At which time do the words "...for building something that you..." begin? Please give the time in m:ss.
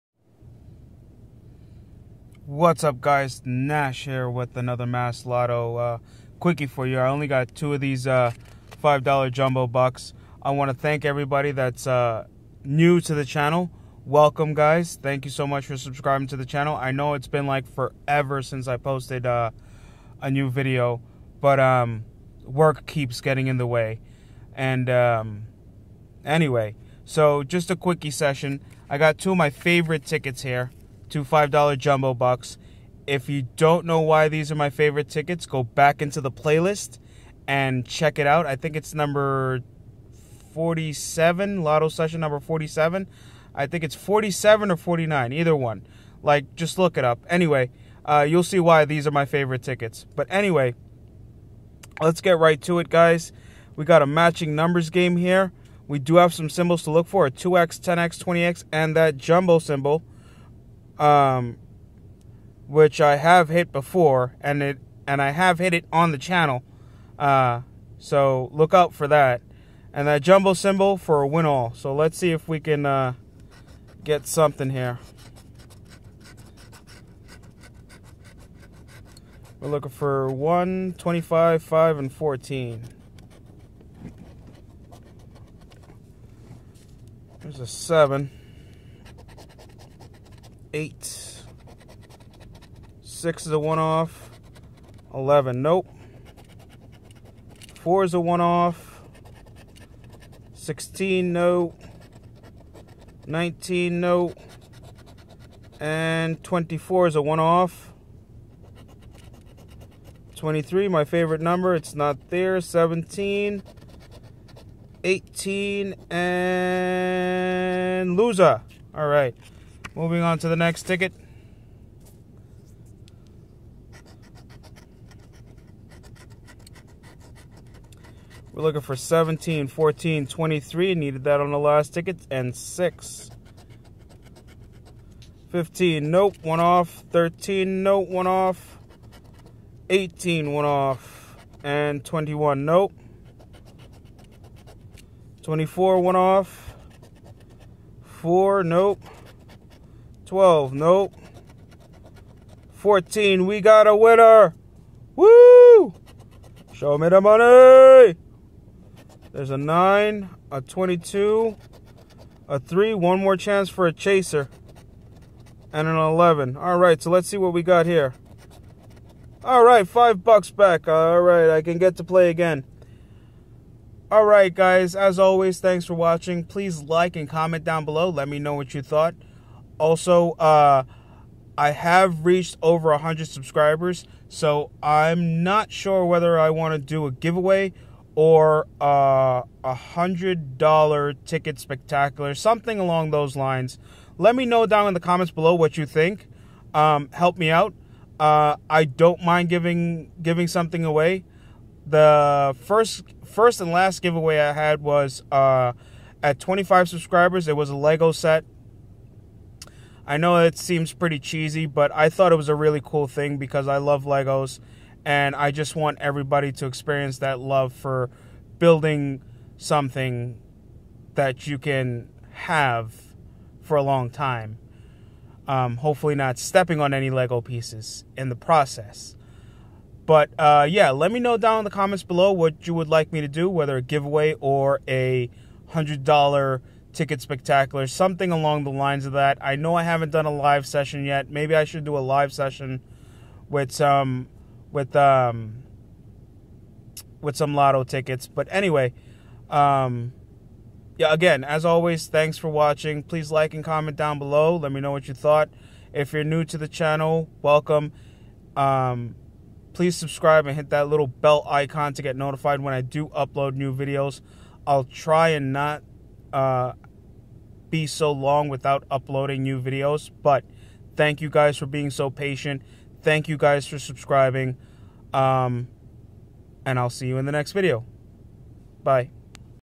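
3:37.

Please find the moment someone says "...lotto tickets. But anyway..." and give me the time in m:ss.
4:07.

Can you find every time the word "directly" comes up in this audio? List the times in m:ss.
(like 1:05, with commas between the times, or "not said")
not said.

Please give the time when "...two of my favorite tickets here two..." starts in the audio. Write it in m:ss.
0:29.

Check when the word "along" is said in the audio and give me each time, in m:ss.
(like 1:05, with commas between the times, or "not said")
3:12, 3:58.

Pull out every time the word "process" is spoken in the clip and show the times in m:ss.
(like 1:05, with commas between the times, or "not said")
3:48.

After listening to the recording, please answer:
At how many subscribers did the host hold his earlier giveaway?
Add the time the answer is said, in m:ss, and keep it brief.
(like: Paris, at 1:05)
25, at 3:26.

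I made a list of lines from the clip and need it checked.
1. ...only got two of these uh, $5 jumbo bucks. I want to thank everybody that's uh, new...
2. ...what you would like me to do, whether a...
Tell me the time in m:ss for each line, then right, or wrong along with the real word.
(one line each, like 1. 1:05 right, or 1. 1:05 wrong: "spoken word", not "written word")
1. 0:07 right
2. 3:52 right.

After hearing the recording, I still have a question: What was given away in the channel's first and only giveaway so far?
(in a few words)
A Lego set.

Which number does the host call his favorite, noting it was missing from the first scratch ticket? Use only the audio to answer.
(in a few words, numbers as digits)
23.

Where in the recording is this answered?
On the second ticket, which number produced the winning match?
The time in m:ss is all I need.
2:32.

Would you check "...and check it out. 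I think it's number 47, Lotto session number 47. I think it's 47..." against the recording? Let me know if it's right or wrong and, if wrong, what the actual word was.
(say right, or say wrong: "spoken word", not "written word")
right.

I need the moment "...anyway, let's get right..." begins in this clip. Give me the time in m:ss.
0:50.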